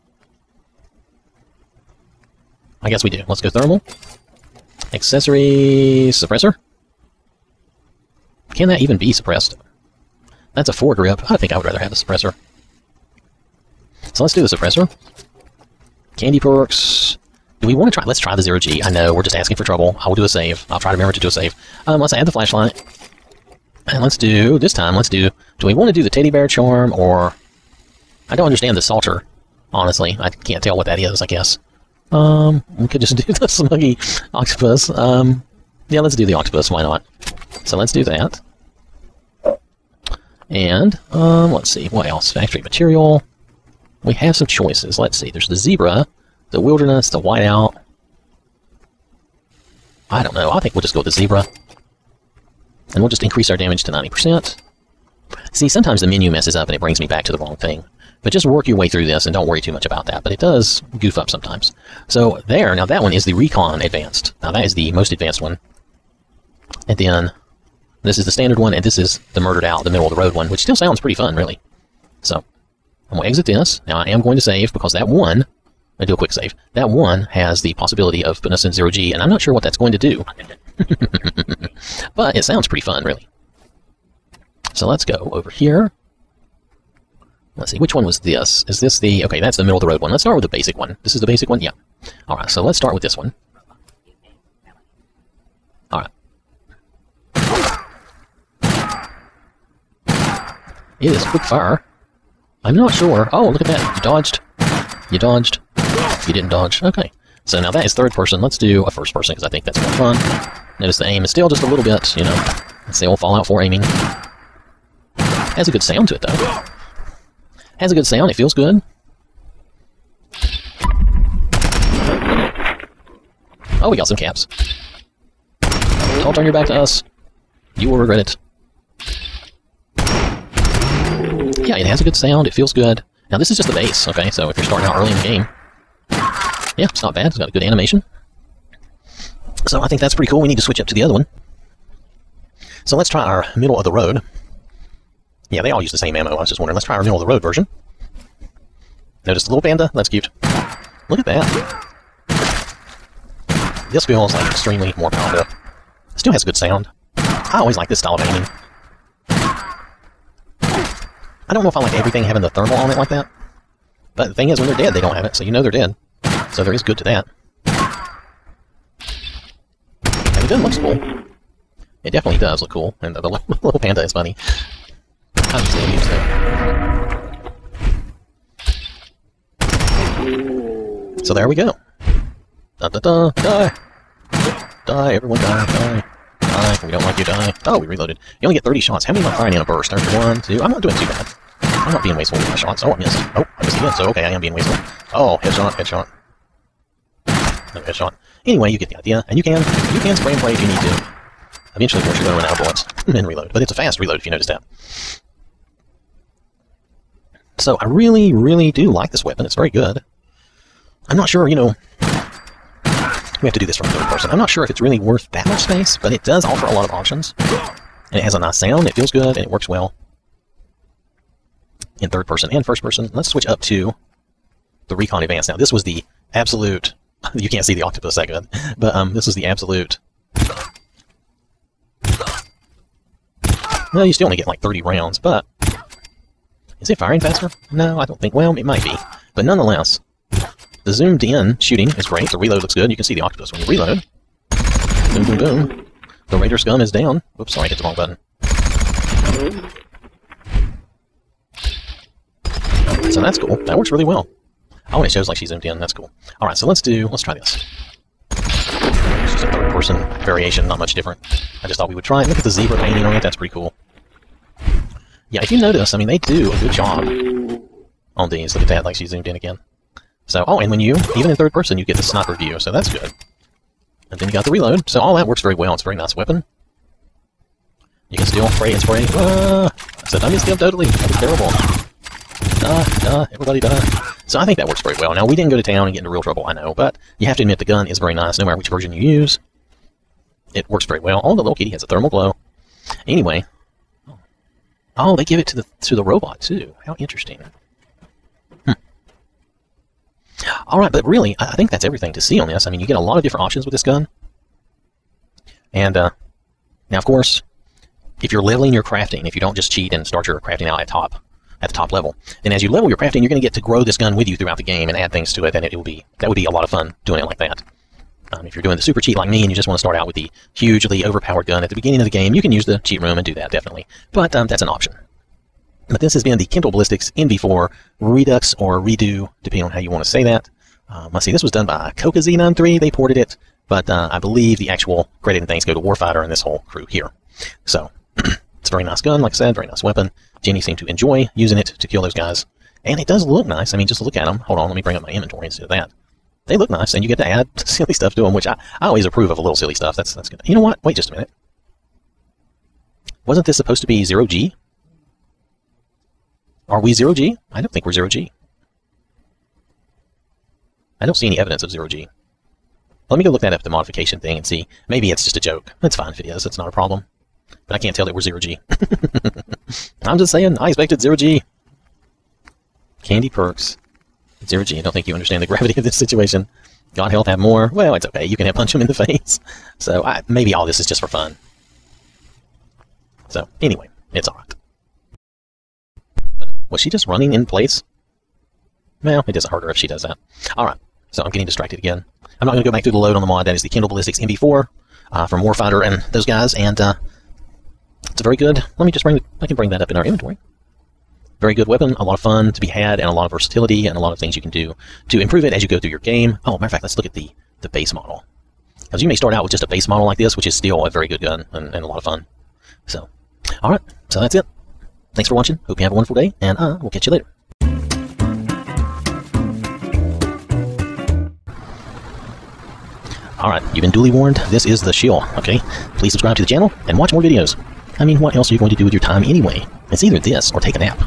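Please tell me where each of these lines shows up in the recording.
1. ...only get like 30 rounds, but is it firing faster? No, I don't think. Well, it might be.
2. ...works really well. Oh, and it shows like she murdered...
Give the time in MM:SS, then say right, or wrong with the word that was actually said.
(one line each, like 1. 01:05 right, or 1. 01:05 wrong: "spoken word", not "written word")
1. 03:54 right
2. 04:13 wrong: "zoomed", not "murdered".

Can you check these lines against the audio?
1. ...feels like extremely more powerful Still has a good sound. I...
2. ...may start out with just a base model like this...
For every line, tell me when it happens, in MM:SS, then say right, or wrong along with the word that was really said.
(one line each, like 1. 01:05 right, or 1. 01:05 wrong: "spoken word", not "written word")
1. 02:34 right
2. 06:49 right.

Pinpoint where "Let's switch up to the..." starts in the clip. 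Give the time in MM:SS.
03:43.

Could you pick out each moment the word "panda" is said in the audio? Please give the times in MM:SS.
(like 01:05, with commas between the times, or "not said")
02:29, 02:53.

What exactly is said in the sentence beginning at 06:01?
I don't see any evidence of zero G.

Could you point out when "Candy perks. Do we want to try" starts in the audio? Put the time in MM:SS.
00:16.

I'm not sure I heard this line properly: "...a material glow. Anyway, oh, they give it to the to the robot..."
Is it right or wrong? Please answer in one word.
wrong.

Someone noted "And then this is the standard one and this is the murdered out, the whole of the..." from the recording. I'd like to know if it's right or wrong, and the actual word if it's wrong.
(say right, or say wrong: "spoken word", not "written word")
wrong: "middle", not "whole".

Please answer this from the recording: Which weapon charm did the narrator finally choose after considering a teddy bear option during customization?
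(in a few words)
smuggy octopus.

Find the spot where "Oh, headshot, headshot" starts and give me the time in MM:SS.
03:15.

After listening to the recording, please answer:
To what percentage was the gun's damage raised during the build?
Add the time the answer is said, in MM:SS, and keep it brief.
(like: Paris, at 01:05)
90%, at 00:53.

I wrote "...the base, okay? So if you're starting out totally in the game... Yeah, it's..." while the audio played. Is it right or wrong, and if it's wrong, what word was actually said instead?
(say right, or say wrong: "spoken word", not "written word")
wrong: "early", not "totally".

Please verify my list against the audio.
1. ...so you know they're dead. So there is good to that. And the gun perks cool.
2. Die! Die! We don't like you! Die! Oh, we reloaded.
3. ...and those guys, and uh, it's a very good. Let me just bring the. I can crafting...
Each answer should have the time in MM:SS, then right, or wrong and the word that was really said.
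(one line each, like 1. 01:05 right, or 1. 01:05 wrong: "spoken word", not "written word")
1. 02:45 wrong: "looks", not "perks"
2. 03:06 right
3. 06:35 wrong: "bring", not "crafting".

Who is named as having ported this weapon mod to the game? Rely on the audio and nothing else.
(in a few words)
Kokazi93.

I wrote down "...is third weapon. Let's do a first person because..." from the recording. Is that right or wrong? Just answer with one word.
wrong.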